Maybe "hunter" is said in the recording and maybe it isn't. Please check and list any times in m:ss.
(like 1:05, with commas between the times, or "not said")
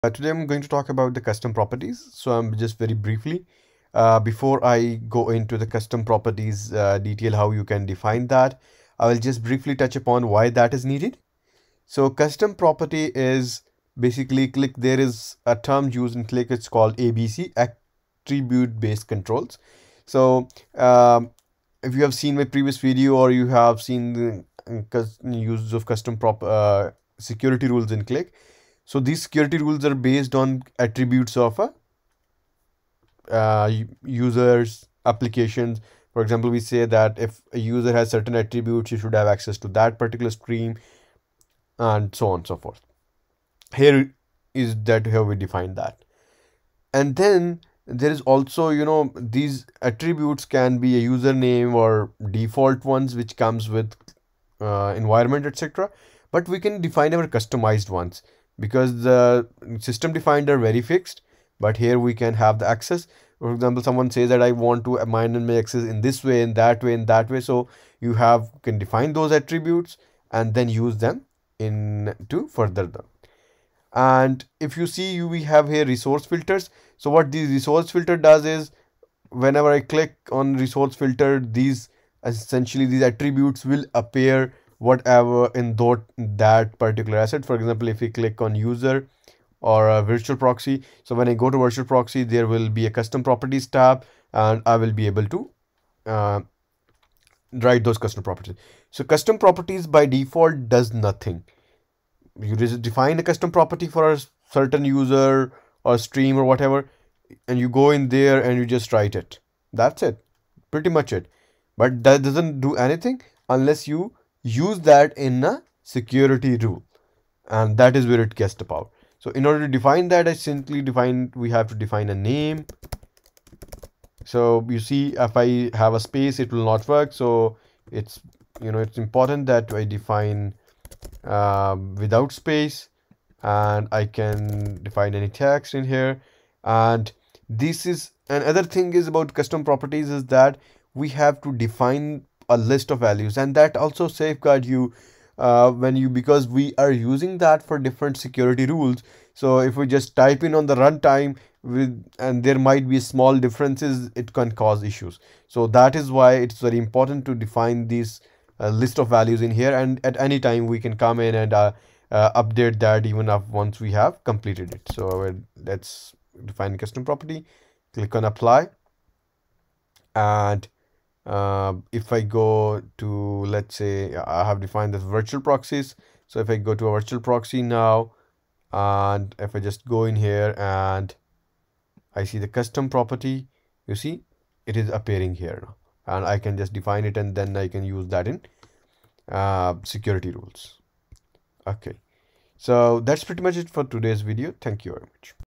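not said.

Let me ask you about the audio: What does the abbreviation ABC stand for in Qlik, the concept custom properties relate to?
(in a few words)
attribute based controls.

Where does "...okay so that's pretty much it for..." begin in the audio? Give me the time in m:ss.
3:11.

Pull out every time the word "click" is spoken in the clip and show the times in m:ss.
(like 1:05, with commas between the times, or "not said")
1:19, 1:28, 2:47.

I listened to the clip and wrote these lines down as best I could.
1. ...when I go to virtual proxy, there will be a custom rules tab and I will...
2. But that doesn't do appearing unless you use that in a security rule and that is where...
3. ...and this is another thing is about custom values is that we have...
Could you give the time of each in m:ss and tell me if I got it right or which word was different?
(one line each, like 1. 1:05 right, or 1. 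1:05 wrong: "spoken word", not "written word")
1. 1:31 wrong: "properties", not "rules"
2. 1:51 wrong: "anything", not "appearing"
3. 2:16 wrong: "properties", not "values".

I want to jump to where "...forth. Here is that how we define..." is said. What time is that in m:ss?
0:42.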